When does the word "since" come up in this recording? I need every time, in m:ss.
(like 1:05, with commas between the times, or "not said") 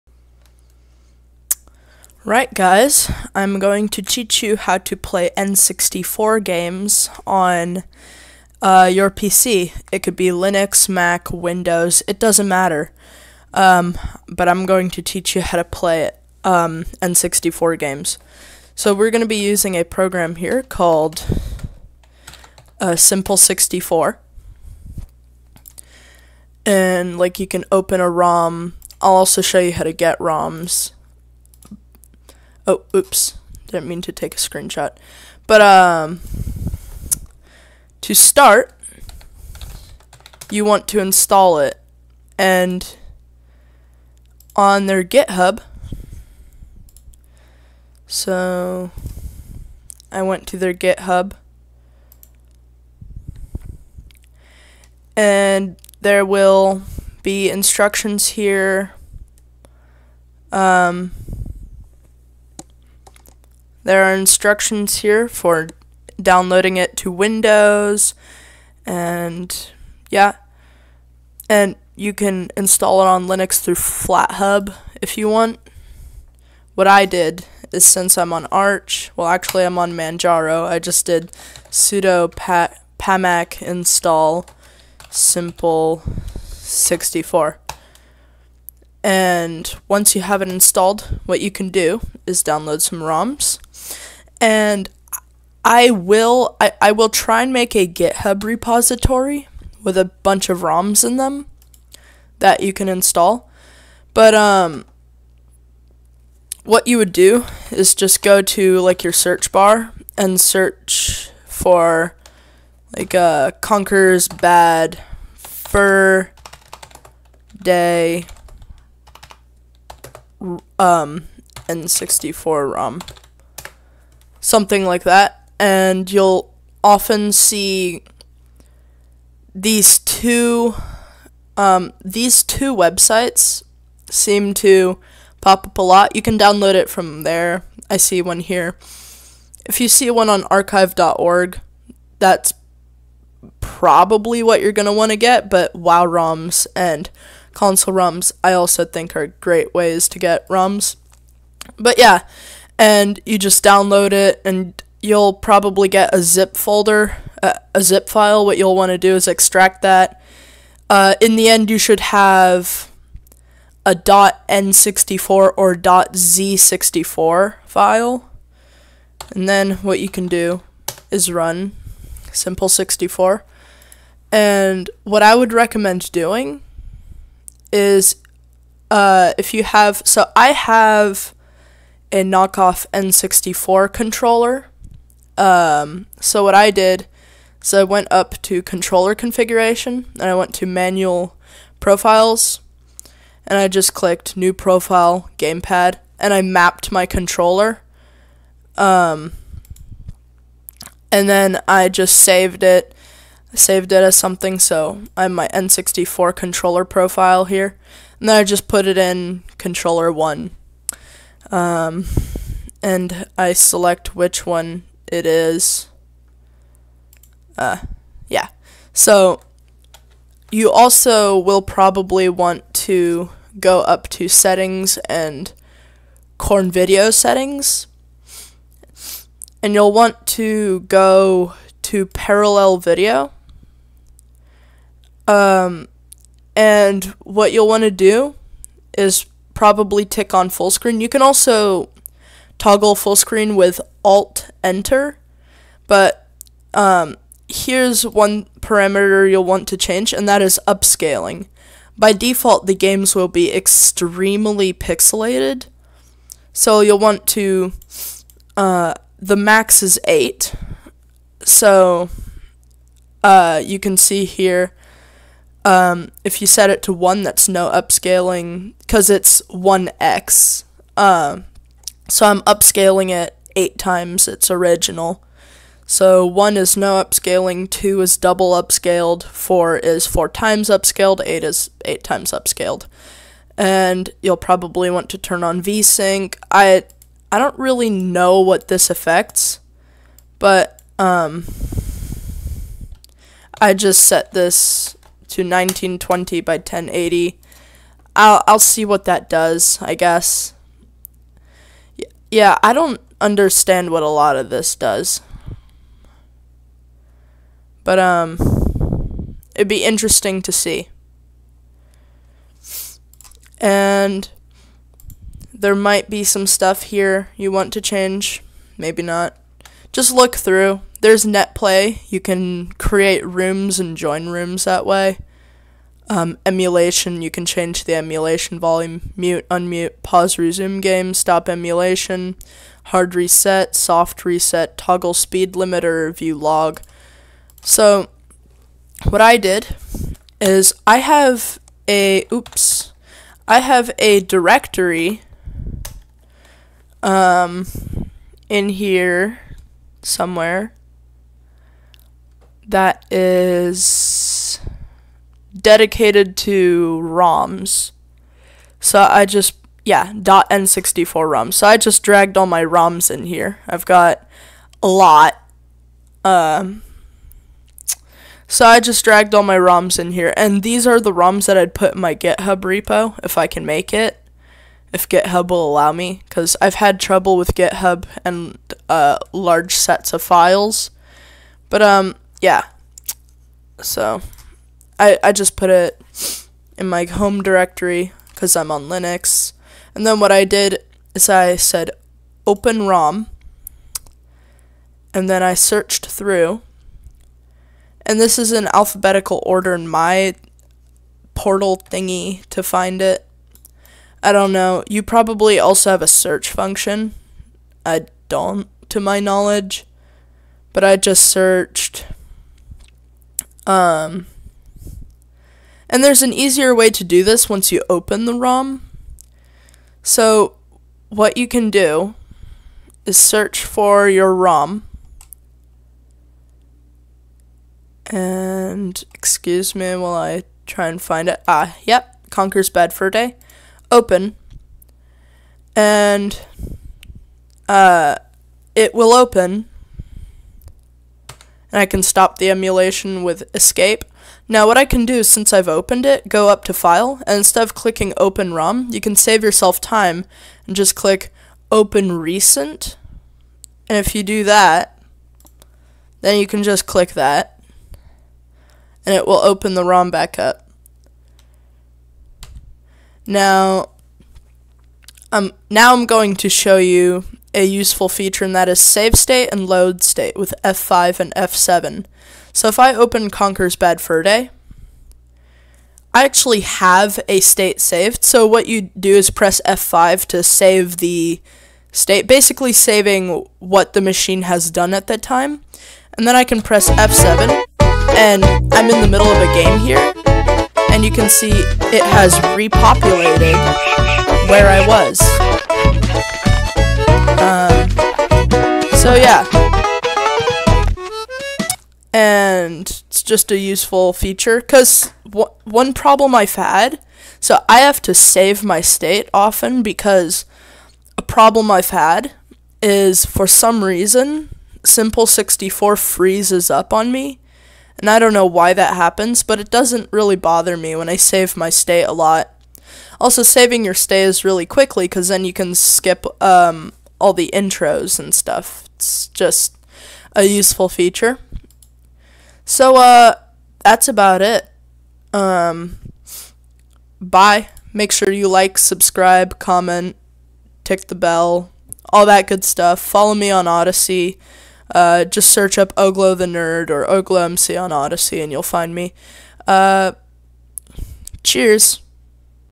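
1:17, 7:25.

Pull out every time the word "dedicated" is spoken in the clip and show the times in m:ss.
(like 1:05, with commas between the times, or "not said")
5:55.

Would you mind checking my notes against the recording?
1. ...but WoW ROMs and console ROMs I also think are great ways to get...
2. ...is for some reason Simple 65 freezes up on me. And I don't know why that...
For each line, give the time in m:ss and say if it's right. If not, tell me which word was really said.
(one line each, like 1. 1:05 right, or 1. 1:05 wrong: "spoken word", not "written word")
1. 2:25 right
2. 8:32 wrong: "64", not "65".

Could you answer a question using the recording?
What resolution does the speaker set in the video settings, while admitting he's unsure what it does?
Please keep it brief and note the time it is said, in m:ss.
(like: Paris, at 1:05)
1920 by 1080, at 4:55.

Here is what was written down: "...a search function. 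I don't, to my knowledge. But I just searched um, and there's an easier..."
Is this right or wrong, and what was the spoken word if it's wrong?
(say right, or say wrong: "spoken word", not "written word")
right.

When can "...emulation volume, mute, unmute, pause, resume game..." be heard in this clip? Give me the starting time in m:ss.
5:27.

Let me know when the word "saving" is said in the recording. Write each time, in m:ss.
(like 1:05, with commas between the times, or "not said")
8:02, 8:43.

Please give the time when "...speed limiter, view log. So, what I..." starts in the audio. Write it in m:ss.
5:35.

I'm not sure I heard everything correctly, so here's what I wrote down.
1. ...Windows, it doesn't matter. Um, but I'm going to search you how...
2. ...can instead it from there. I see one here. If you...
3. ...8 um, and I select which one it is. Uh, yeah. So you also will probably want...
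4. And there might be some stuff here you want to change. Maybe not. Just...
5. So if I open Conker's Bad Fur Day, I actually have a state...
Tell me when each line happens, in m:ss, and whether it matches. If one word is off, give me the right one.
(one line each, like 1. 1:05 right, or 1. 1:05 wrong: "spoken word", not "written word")
1. 0:11 wrong: "teach", not "search"
2. 2:16 wrong: "download", not "instead"
3. 3:30 wrong: "1", not "8"
4. 5:13 right
5. 7:52 right.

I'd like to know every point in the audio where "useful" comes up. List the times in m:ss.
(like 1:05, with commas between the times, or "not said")
7:47, 8:23, 8:50.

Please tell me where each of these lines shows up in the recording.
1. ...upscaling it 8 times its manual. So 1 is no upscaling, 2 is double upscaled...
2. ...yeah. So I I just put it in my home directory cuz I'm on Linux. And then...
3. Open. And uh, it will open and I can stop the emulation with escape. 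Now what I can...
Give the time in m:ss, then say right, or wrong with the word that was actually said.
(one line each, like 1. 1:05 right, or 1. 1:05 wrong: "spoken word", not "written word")
1. 4:32 wrong: "original", not "manual"
2. 6:22 right
3. 7:13 right.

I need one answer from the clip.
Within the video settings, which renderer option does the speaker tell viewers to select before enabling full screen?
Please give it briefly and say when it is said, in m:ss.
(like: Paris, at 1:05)
parallel video, at 3:52.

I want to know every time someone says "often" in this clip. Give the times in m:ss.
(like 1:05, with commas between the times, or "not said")
2:06, 8:29.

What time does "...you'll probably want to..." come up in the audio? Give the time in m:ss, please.
4:44.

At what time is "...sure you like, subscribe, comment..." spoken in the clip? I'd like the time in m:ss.
8:58.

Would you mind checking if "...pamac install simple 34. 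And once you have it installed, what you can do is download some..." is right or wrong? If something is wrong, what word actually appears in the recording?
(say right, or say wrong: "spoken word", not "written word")
wrong: "64", not "34".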